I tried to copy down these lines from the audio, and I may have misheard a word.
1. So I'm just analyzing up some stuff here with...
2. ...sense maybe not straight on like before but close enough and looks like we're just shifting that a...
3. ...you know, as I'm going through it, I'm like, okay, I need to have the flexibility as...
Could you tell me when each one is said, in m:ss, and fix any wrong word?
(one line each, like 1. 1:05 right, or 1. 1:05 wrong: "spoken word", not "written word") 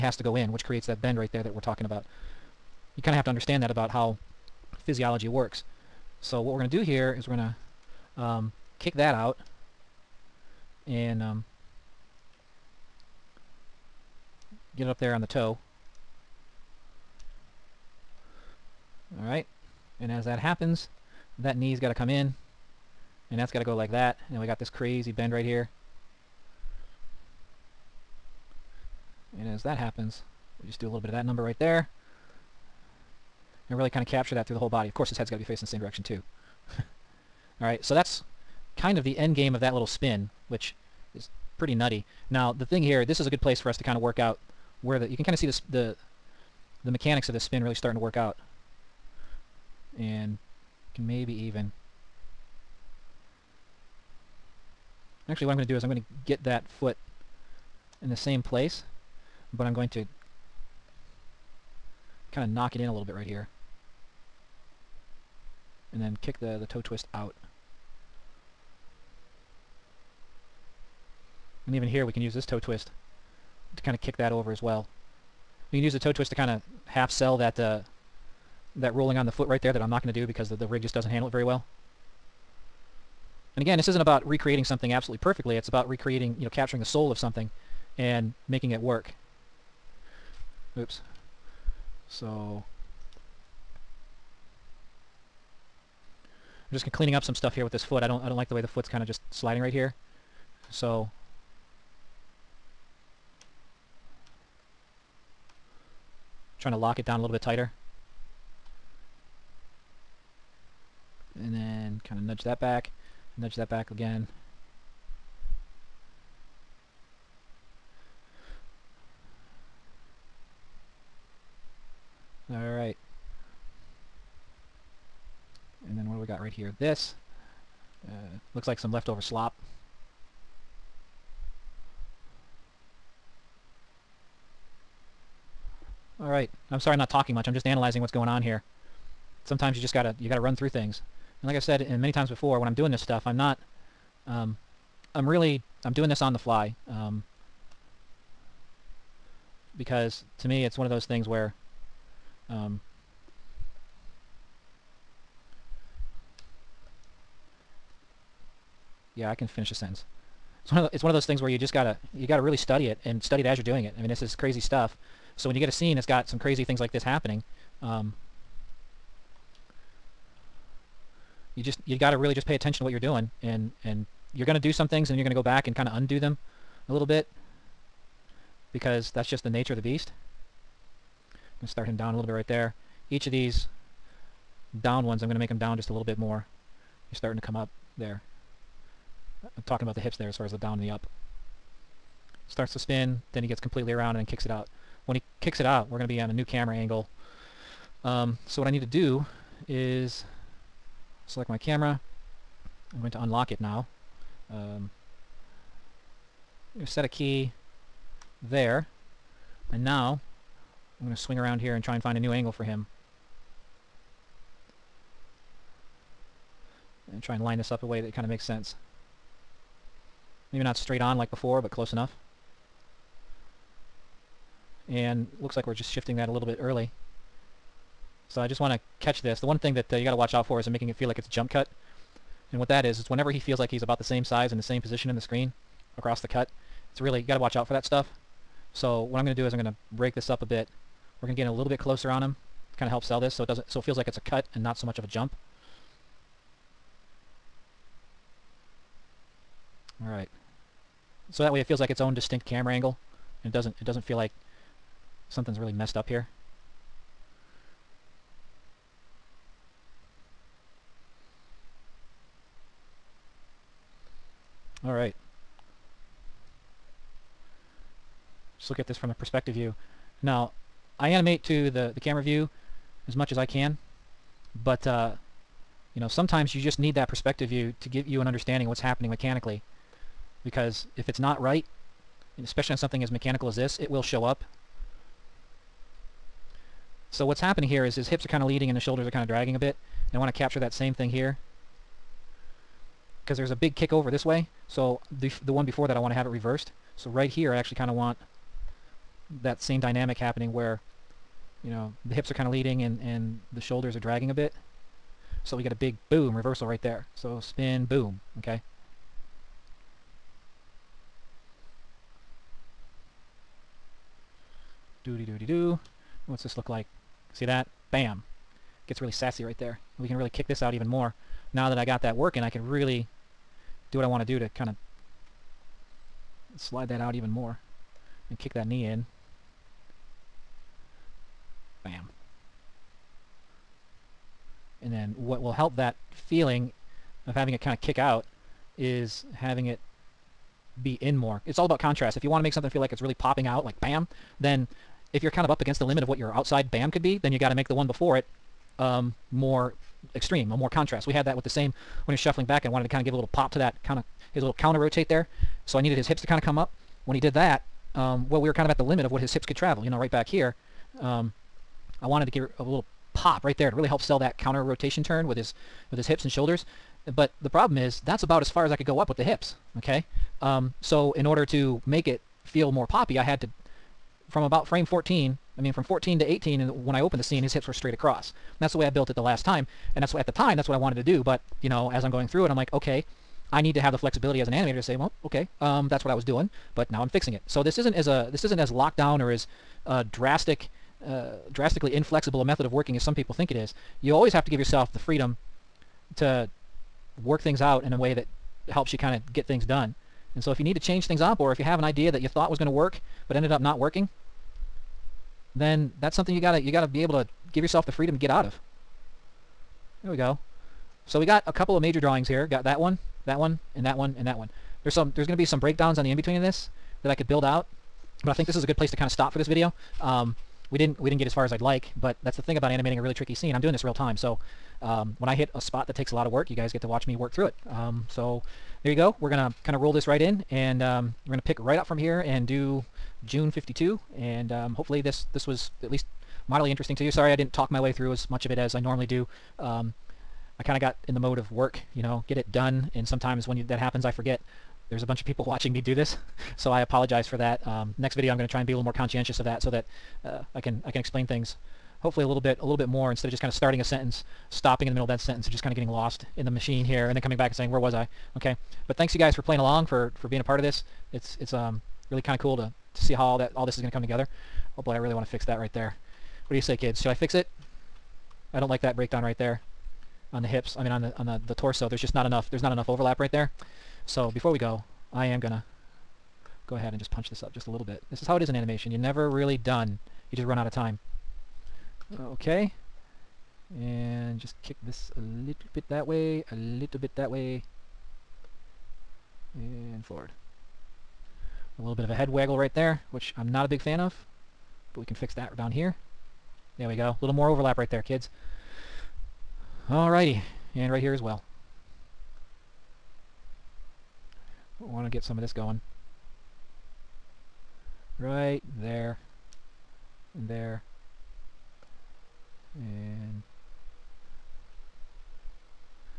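1. 1:32 wrong: "cleaning", not "analyzing"
2. 3:38 right
3. 6:21 right.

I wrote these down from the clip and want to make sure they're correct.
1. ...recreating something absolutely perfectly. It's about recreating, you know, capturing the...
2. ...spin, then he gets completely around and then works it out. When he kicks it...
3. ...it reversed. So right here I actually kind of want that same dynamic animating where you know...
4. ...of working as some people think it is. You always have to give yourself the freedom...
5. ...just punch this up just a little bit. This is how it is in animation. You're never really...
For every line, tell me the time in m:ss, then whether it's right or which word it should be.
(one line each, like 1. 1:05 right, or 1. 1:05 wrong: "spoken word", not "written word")
1. 1:24 right
2. 3:12 wrong: "kicks", not "works"
3. 4:56 wrong: "happening", not "animating"
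4. 6:32 right
5. 7:56 right.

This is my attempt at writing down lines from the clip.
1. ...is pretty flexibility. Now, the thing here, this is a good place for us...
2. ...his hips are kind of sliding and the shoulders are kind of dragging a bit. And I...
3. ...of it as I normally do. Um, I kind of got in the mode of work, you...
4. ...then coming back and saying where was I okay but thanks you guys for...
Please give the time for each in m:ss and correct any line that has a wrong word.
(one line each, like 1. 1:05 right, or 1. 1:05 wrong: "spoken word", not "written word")
1. 0:41 wrong: "nutty", not "flexibility"
2. 4:47 wrong: "leading", not "sliding"
3. 7:18 right
4. 7:37 right.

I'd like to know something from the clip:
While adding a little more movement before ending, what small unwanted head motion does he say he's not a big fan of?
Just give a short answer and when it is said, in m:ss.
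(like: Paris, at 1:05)
head waggle, at 8:12.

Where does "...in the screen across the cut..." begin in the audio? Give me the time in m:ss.
3:55.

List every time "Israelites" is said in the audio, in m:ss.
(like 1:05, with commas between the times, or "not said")
not said.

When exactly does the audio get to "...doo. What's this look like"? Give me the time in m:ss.
5:15.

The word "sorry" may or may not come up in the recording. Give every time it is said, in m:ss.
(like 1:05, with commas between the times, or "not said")
2:16, 7:17.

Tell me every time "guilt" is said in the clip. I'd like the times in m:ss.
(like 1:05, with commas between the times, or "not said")
not said.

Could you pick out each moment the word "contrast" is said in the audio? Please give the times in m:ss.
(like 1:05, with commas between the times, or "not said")
5:41, 5:50.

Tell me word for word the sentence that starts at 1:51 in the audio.
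And then kind of nudge that back, nudge that back again.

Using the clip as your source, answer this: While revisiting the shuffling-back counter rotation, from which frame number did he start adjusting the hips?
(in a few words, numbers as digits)
14.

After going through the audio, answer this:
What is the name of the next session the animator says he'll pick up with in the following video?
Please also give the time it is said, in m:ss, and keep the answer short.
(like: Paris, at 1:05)
June 52, at 7:13.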